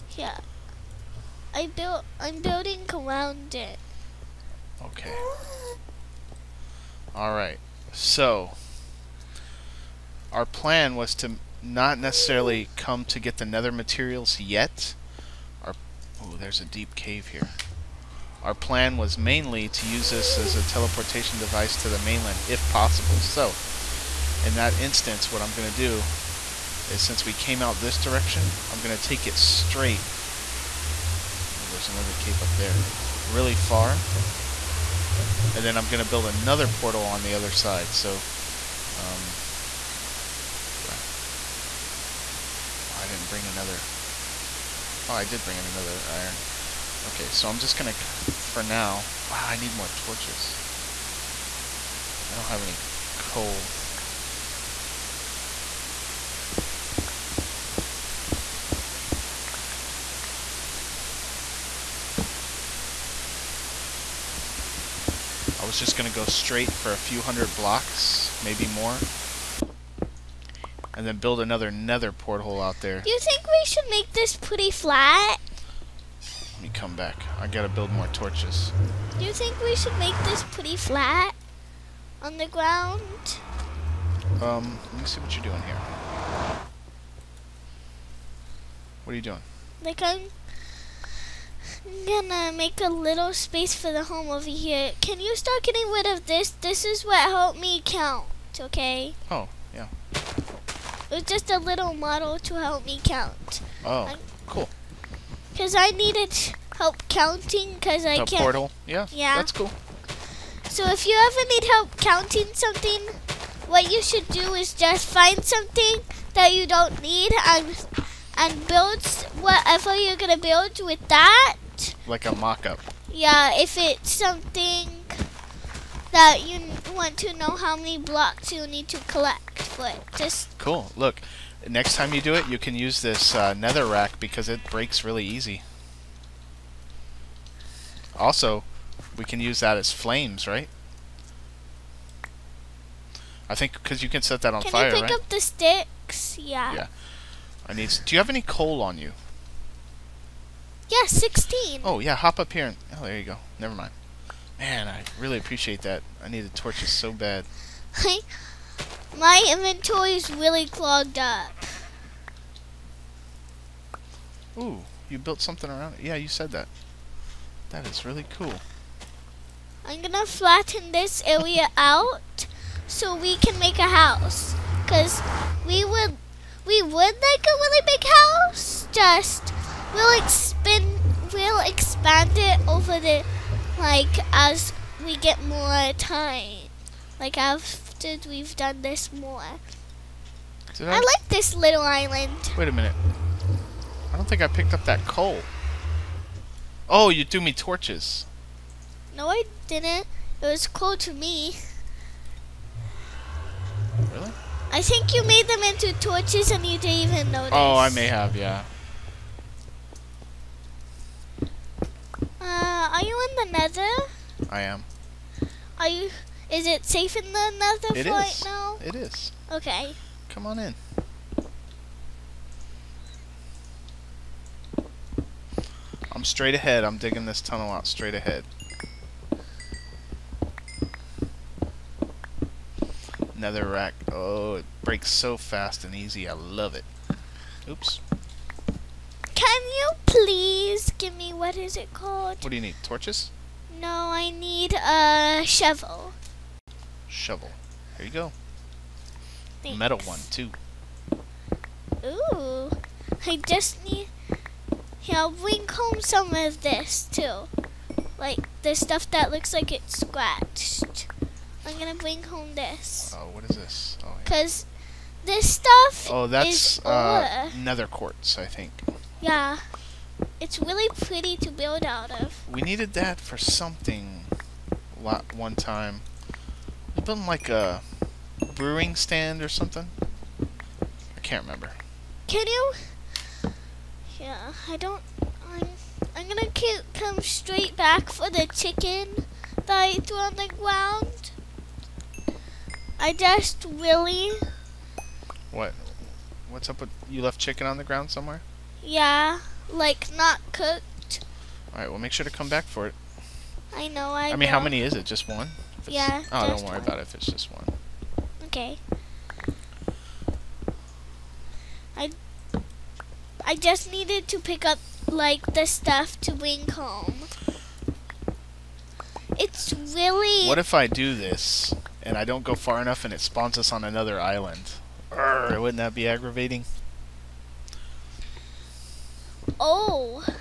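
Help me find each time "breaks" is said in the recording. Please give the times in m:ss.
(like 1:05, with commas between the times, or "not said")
2:14, 3:54.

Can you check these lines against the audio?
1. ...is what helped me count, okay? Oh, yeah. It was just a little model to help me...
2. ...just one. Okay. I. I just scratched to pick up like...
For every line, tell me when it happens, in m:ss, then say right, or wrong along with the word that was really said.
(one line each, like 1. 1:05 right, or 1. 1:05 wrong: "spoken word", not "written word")
1. 1:36 right
2. 5:07 wrong: "needed", not "scratched".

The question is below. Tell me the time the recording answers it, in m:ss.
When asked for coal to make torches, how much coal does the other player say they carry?
2:31.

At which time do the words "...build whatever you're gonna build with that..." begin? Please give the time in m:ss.
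1:58.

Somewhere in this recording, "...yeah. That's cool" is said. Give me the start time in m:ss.
1:49.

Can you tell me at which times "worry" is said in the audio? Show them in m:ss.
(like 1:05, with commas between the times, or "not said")
5:06.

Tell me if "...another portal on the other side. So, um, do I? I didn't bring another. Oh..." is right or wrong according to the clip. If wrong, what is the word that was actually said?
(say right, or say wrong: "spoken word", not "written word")
right.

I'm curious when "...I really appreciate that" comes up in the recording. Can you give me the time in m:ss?
2:34.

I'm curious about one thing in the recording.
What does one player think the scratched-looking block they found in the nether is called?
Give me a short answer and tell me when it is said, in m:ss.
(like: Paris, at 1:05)
Nether quartz, at 4:27.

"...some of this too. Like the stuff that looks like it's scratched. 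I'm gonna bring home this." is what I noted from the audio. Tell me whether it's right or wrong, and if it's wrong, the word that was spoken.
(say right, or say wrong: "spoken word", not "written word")
right.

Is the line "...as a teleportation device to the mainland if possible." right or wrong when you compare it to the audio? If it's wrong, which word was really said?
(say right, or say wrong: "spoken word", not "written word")
right.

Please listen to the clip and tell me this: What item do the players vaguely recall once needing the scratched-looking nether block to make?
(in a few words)
A brewing stand.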